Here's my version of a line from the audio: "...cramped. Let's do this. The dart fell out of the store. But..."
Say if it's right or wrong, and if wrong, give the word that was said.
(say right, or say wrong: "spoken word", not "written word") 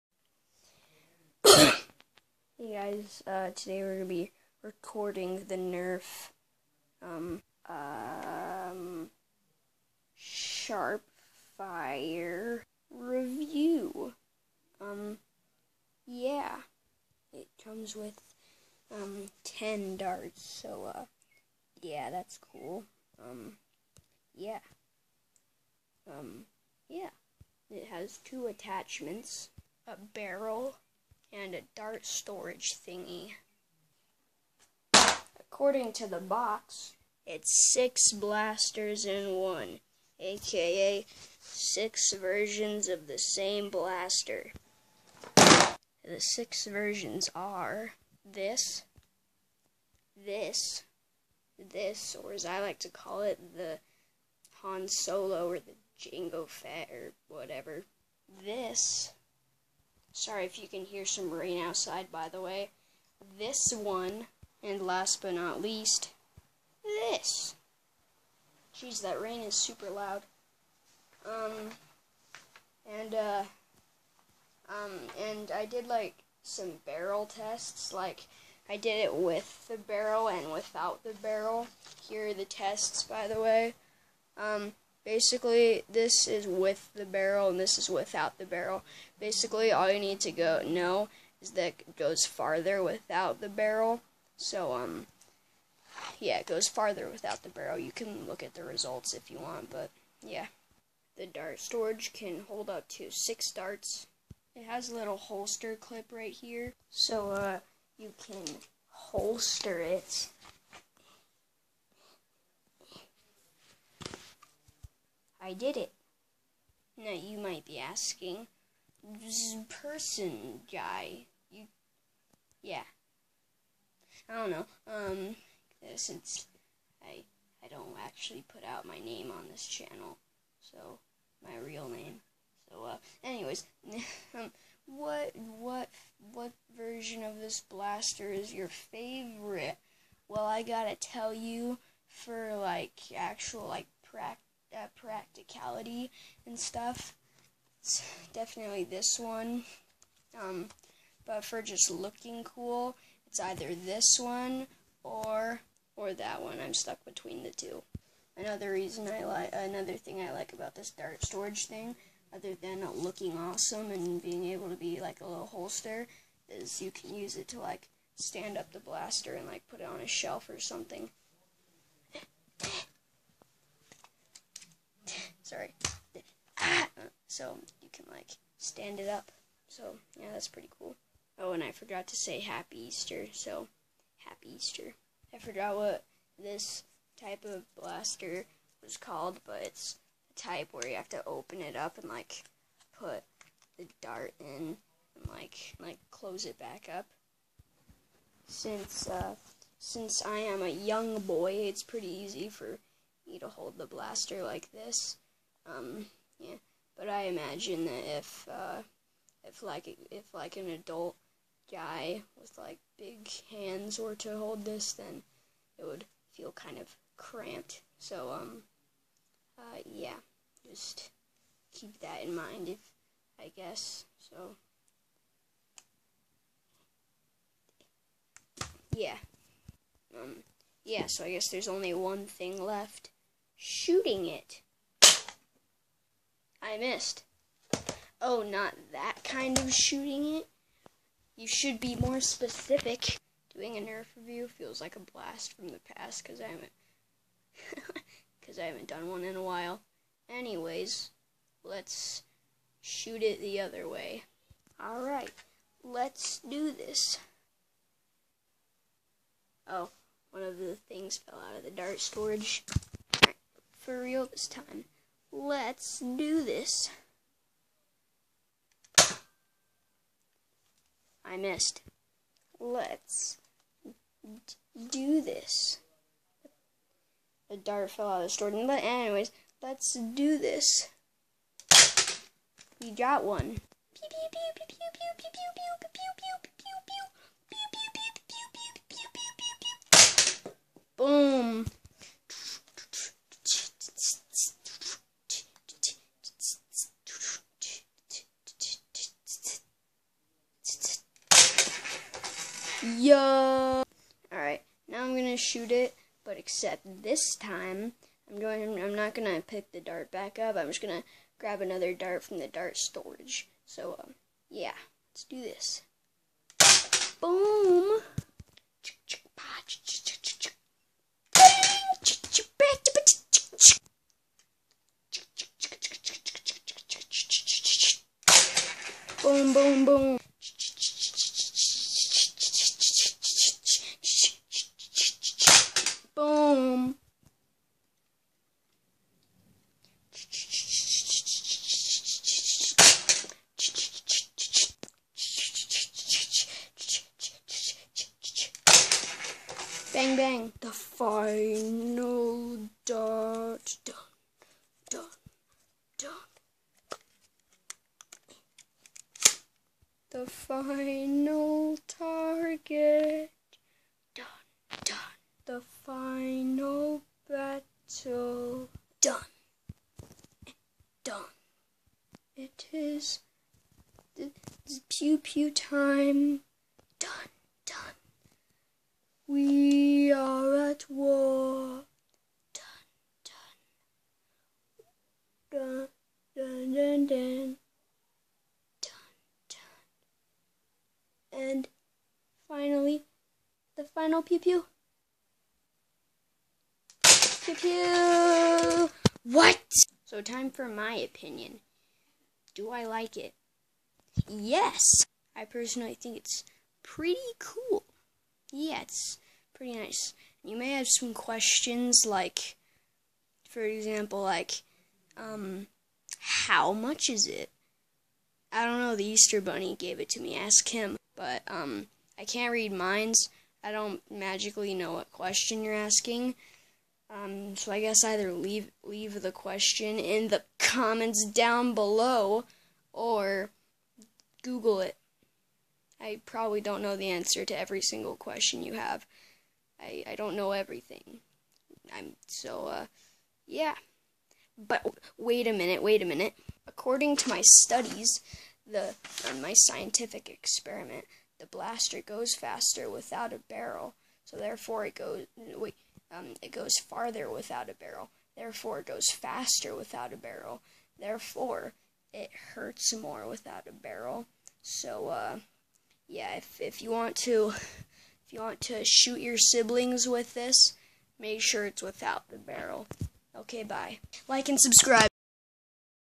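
wrong: "missed", not "cramped".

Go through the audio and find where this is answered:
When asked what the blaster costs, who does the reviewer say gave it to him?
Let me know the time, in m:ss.
6:58.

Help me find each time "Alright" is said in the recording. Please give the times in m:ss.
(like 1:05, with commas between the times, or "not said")
5:04.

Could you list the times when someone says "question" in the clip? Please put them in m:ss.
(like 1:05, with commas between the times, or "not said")
6:51, 7:05, 7:09, 7:18.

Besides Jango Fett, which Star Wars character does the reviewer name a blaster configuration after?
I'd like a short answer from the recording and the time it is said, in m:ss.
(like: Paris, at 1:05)
Han Solo, at 0:53.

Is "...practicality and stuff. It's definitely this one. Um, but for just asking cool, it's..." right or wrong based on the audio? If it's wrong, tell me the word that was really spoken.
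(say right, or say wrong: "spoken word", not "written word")
wrong: "looking", not "asking".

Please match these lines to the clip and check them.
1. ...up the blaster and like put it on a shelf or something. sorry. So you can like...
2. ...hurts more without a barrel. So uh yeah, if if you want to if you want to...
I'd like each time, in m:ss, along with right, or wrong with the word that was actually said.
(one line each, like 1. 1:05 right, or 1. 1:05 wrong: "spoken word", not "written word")
1. 2:48 right
2. 7:42 right.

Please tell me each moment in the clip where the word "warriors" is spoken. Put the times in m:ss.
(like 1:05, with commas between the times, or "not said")
not said.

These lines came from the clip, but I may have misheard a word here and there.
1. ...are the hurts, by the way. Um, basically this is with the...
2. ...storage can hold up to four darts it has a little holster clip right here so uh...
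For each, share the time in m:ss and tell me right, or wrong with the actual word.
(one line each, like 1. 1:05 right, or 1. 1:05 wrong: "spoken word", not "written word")
1. 1:22 wrong: "tests", not "hurts"
2. 1:41 wrong: "six", not "four".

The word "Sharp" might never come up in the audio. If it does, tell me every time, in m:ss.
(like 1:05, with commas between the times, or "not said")
0:10.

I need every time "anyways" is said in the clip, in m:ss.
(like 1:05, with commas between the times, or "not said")
2:13, 4:10, 4:38.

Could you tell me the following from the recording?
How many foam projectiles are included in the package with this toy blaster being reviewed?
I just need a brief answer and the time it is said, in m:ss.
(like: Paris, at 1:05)
10, at 0:19.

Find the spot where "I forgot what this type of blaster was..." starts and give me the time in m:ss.
3:05.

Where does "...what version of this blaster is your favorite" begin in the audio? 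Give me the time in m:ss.
2:16.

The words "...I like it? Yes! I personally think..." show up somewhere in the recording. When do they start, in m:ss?
6:42.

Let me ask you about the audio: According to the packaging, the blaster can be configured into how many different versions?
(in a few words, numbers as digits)
6.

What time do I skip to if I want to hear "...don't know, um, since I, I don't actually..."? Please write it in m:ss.
2:04.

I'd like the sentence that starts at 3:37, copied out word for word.
So um, uh, yeah, just keep that in mind if I guess so.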